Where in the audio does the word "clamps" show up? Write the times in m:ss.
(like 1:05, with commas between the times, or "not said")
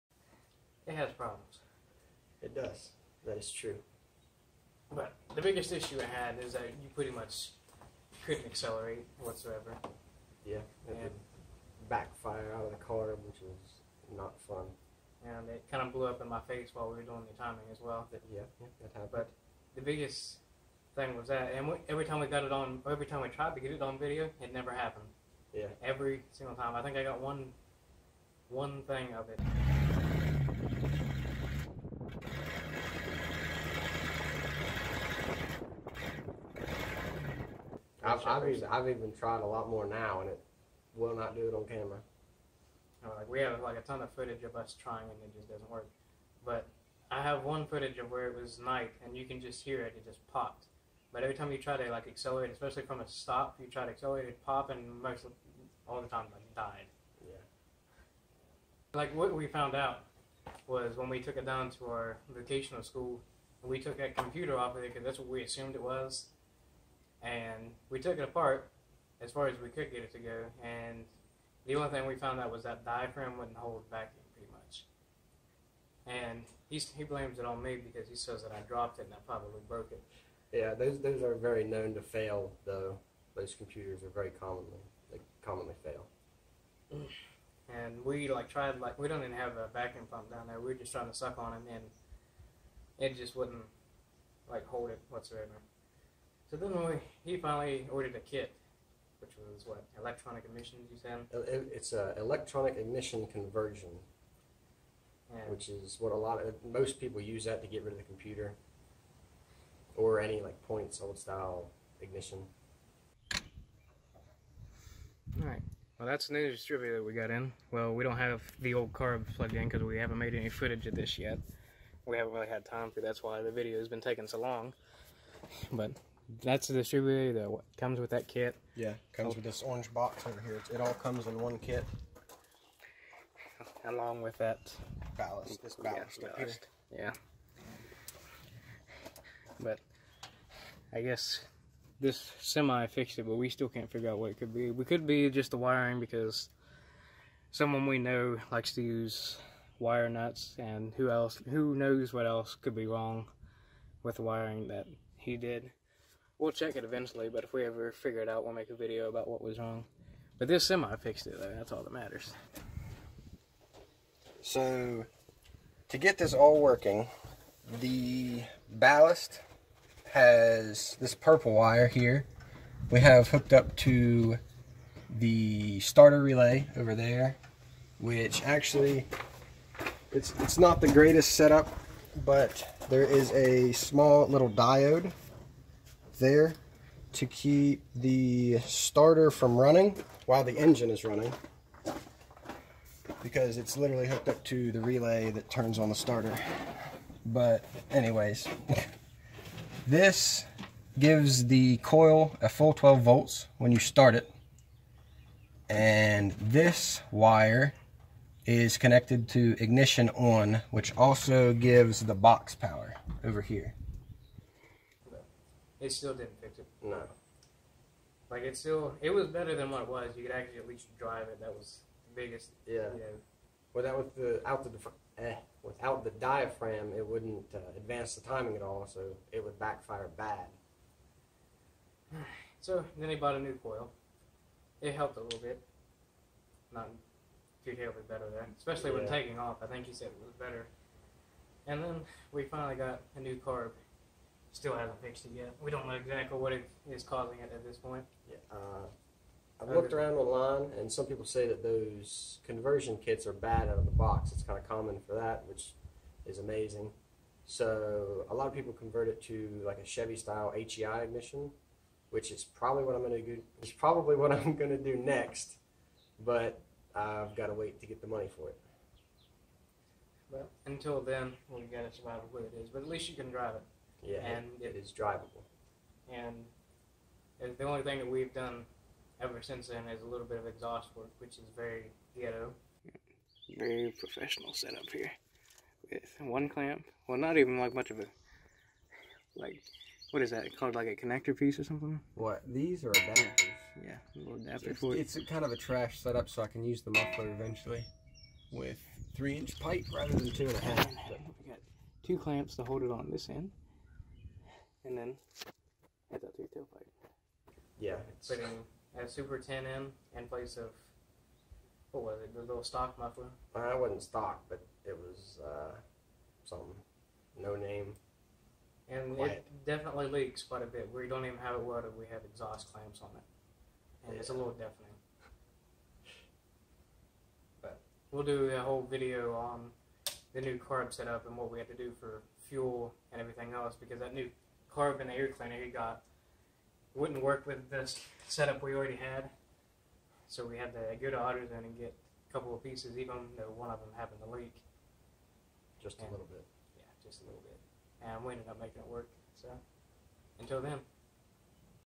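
4:46, 5:02, 5:22.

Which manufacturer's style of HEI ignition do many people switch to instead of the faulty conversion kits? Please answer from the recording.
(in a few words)
Chevy.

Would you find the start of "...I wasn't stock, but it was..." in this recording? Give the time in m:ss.
5:13.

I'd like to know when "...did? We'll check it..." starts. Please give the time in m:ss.
2:35.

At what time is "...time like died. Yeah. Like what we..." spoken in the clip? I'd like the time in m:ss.
0:56.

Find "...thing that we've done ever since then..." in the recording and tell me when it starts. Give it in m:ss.
4:37.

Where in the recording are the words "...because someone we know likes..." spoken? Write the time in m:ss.
2:25.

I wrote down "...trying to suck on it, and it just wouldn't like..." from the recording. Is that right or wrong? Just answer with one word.
right.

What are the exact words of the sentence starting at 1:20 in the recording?
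Yeah, those those are very known to fail though.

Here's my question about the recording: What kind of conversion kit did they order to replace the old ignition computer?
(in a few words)
Electronic ignition conversion.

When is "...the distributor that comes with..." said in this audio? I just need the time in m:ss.
2:06.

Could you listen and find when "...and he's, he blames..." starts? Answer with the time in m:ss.
1:16.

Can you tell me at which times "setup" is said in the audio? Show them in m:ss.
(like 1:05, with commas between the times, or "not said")
3:01, 4:44, 4:55, 5:30, 5:38.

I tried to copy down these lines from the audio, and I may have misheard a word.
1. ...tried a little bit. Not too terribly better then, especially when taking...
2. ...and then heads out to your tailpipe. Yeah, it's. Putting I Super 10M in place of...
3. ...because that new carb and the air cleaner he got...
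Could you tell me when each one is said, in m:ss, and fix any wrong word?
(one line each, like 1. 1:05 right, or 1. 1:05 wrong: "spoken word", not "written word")
1. 3:54 wrong: "helped", not "tried"
2. 5:04 right
3. 5:33 right.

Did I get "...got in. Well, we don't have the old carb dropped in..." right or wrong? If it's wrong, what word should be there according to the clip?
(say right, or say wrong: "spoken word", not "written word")
wrong: "plugged", not "dropped".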